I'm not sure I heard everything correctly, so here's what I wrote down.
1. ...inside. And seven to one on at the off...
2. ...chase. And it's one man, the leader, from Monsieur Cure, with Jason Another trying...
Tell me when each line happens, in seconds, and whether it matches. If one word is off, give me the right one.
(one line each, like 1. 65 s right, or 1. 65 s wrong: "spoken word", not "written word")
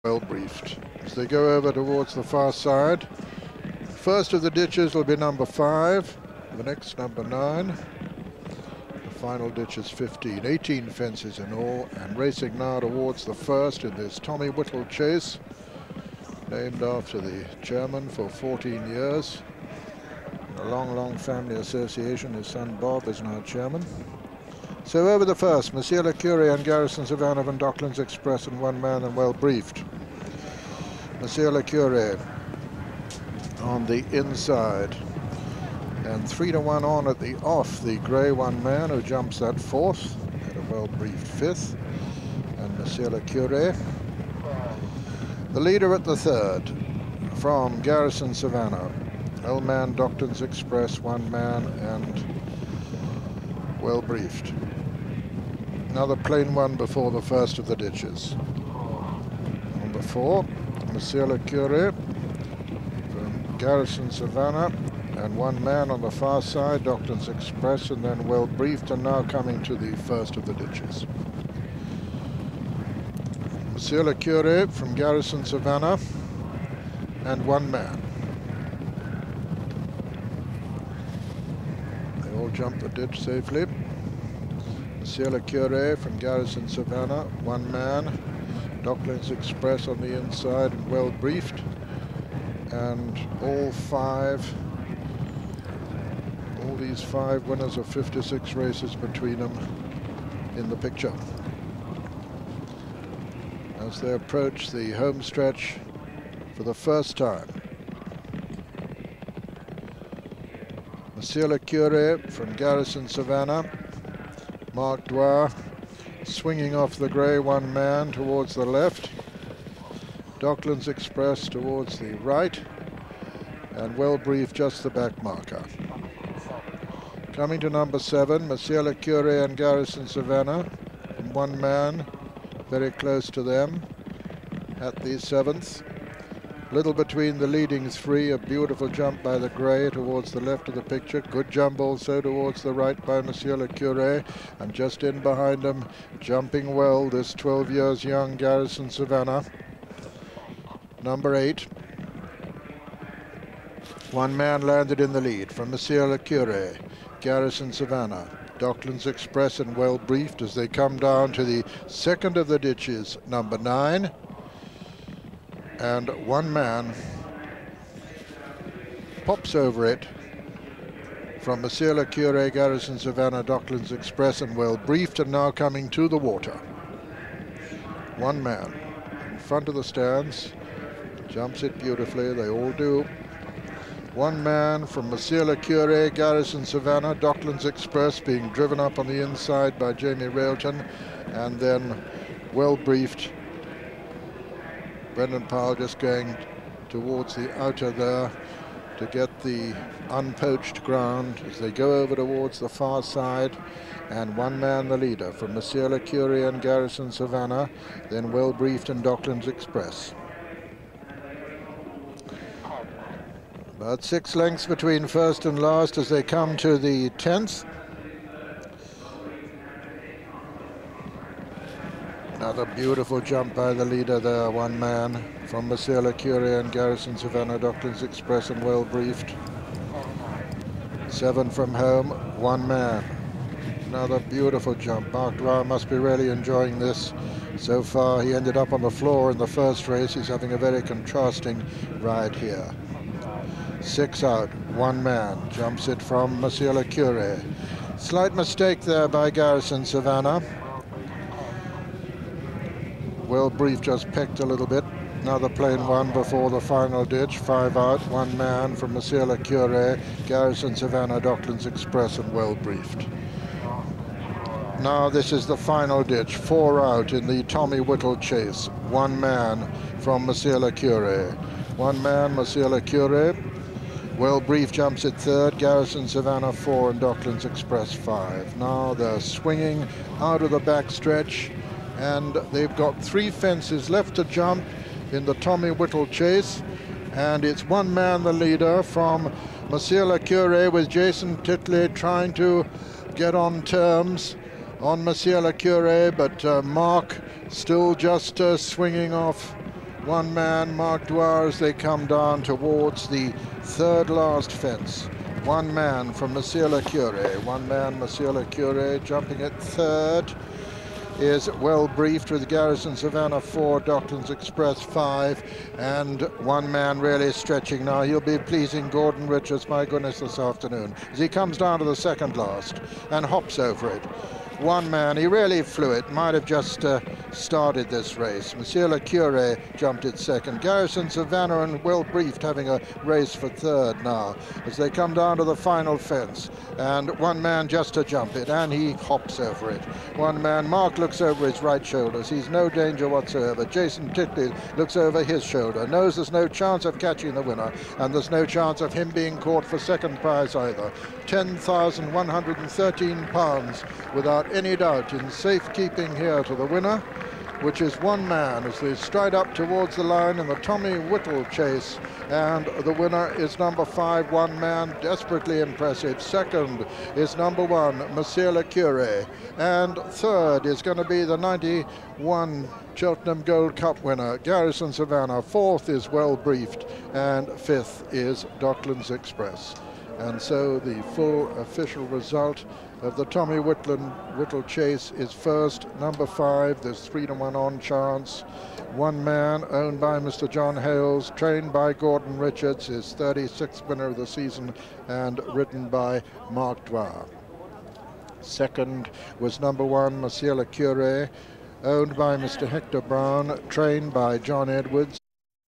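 1. 34 s wrong: "three", not "seven"
2. 286 s wrong: "Titley", not "Another".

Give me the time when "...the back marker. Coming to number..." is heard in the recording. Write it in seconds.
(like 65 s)
124 s.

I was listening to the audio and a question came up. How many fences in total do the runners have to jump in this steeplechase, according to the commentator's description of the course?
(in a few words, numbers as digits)
18.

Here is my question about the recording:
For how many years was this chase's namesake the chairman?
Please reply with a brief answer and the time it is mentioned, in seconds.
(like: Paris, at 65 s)
14, at 18 s.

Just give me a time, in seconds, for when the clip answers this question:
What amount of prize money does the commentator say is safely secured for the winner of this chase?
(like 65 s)
351 s.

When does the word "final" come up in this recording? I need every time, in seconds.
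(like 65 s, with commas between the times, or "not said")
9 s, 256 s, 265 s, 335 s.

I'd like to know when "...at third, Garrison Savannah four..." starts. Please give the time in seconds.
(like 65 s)
275 s.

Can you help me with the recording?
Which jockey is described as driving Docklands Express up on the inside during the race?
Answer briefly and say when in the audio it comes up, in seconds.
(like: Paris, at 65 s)
Jamie Railton, at 189 s.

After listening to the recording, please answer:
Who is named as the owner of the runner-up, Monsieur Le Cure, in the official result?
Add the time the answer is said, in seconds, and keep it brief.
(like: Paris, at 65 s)
Hector Brown, at 402 s.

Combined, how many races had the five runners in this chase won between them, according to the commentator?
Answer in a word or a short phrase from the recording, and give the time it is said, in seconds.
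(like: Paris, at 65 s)
56, at 97 s.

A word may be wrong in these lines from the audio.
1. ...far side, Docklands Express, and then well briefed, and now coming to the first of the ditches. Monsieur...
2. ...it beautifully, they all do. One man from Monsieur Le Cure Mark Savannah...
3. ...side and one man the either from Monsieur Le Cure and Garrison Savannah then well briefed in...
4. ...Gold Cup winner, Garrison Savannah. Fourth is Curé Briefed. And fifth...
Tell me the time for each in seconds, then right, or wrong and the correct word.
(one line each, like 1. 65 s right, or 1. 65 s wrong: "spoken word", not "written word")
1. 66 s right
2. 181 s wrong: "Garrison", not "Mark"
3. 203 s wrong: "leader", not "either"
4. 373 s wrong: "Well", not "Curé".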